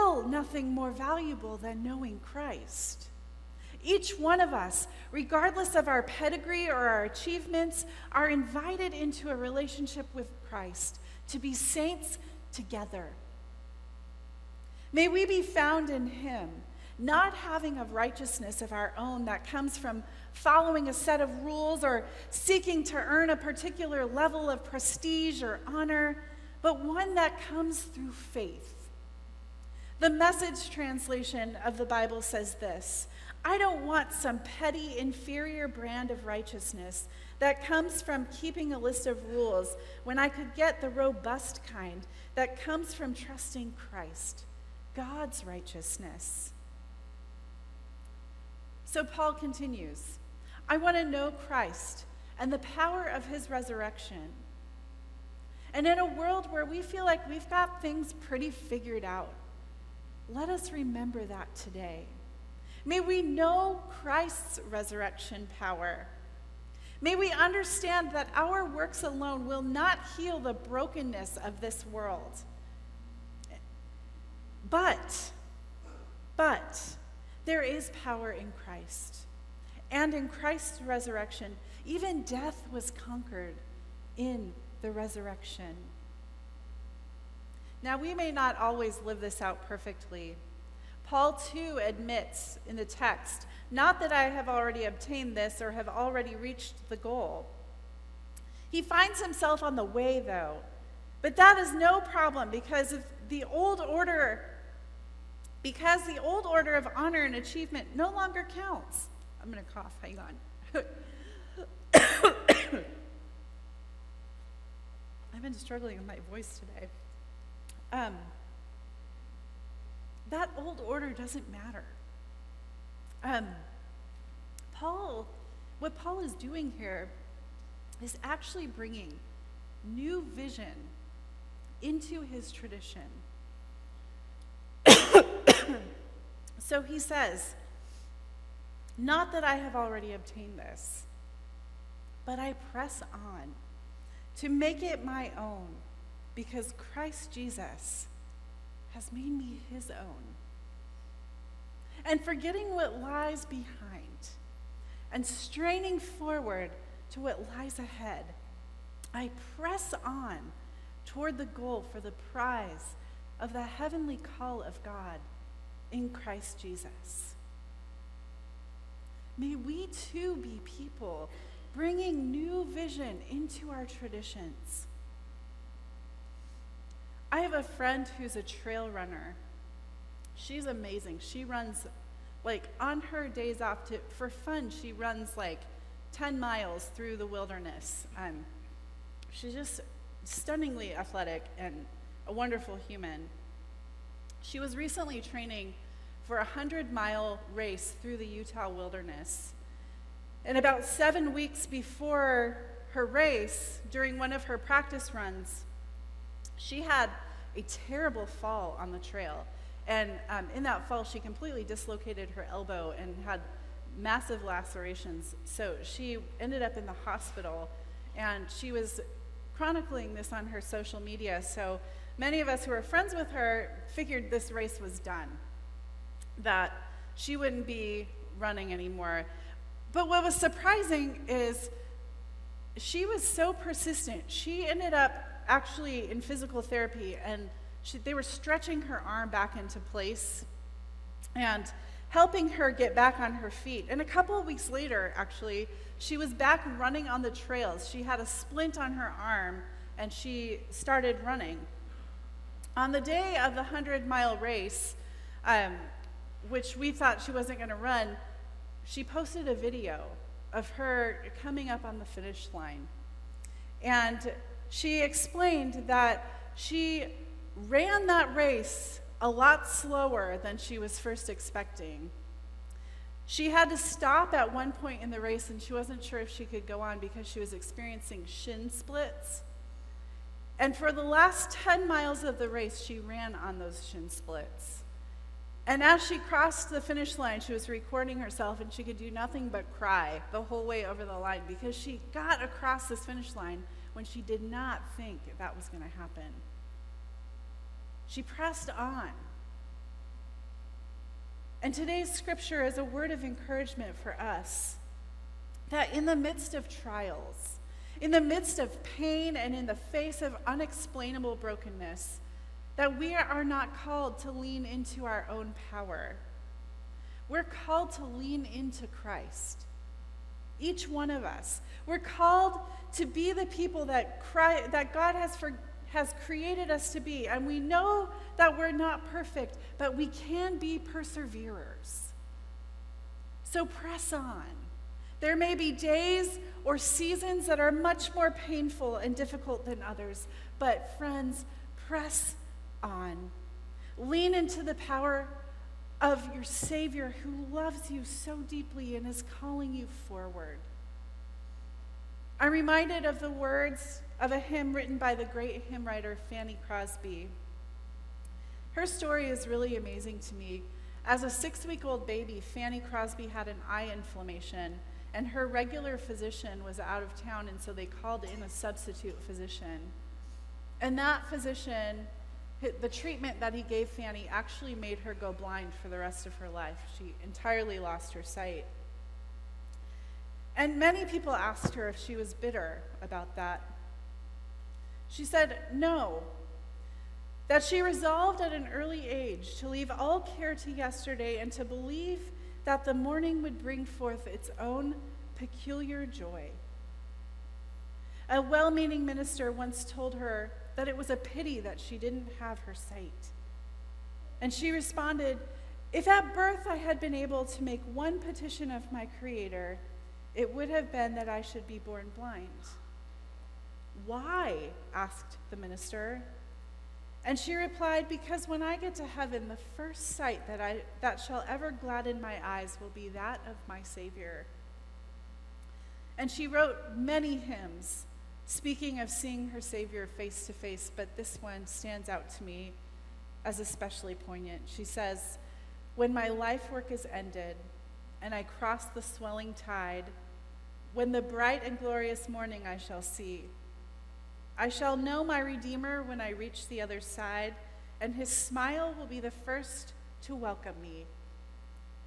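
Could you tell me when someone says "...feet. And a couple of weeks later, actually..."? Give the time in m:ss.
4:03.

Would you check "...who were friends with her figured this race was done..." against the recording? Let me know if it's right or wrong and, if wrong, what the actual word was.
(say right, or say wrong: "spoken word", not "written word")
right.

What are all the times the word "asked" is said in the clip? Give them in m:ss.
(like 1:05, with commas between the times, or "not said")
6:21, 6:54.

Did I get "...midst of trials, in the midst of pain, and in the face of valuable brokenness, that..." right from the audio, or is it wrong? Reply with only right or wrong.
wrong.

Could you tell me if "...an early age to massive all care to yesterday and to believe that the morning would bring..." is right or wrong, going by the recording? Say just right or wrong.
wrong.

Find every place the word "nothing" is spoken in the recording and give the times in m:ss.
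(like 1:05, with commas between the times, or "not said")
0:00, 4:49.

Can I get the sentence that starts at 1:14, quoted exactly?
But, but, there is power in Christ.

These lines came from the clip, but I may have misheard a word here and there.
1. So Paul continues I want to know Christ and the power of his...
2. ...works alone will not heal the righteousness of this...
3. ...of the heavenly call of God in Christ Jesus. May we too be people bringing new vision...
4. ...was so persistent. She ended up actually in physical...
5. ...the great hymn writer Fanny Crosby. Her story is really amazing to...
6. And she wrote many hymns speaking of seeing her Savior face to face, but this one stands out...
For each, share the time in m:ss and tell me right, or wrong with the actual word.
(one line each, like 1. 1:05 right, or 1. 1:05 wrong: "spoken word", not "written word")
1. 0:48 right
2. 1:08 wrong: "brokenness", not "righteousness"
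3. 2:43 right
4. 3:53 right
5. 5:55 right
6. 7:06 right.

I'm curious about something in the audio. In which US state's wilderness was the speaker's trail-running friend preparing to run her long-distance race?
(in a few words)
Utah.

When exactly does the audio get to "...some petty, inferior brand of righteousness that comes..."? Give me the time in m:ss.
0:34.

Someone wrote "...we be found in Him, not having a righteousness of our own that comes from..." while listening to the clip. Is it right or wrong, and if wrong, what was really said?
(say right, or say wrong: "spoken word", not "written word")
right.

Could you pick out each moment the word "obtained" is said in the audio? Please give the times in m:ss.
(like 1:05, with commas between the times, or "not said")
1:34, 2:20.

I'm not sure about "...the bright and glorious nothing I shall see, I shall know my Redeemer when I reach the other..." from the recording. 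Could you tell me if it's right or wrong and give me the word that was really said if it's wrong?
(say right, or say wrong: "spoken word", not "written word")
wrong: "morning", not "nothing".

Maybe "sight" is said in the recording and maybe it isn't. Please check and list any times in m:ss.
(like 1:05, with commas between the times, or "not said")
6:18, 6:42, 7:00.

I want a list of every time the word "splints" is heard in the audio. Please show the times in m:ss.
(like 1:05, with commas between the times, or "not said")
4:08, 4:38, 4:44.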